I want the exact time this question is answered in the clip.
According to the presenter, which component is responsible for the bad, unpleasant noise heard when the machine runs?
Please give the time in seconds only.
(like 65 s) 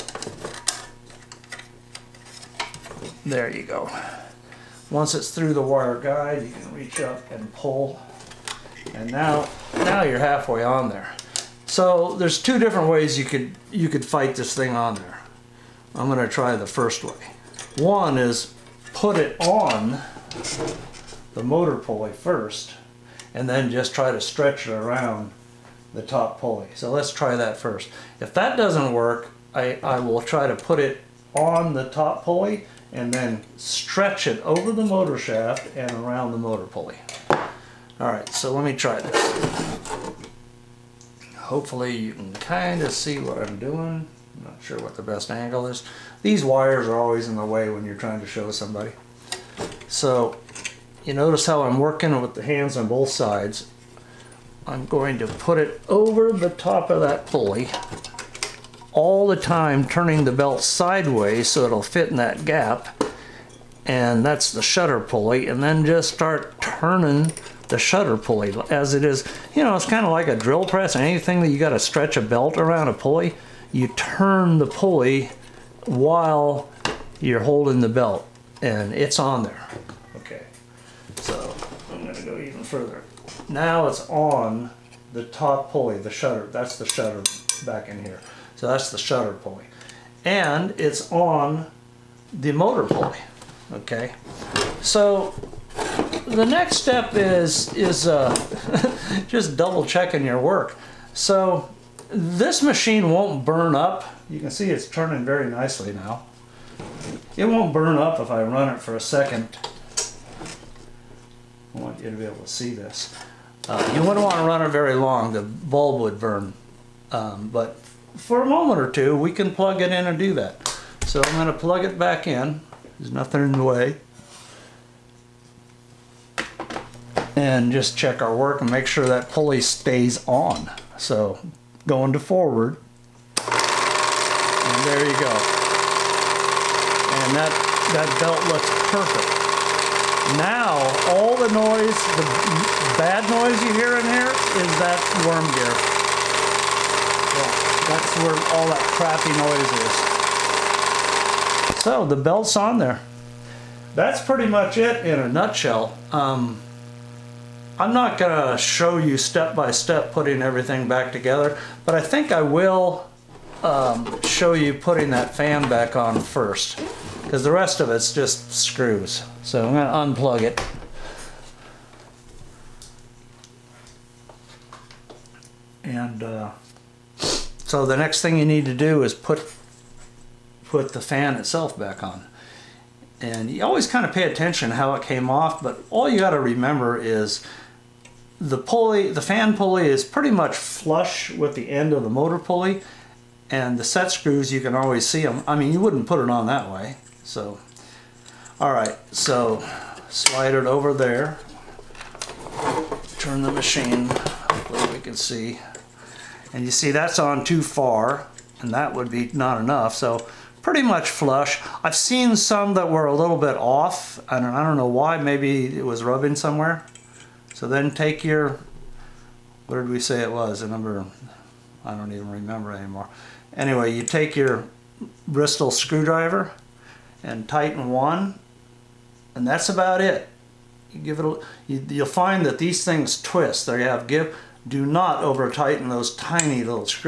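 145 s.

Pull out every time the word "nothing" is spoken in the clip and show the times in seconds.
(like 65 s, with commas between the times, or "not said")
123 s.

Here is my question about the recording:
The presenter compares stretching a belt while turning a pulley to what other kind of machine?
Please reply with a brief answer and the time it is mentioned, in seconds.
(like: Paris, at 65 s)
drill press, at 70 s.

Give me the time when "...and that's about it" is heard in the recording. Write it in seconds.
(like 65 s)
229 s.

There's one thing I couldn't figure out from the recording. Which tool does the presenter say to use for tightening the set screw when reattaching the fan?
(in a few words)
Bristol screwdriver.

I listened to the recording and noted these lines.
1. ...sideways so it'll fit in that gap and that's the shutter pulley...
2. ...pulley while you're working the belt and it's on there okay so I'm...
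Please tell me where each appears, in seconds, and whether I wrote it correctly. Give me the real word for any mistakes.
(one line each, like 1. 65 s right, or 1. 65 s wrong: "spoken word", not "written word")
1. 60 s right
2. 74 s wrong: "holding", not "working".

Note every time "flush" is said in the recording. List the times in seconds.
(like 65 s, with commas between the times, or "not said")
190 s, 211 s.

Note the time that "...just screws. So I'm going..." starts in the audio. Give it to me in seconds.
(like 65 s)
168 s.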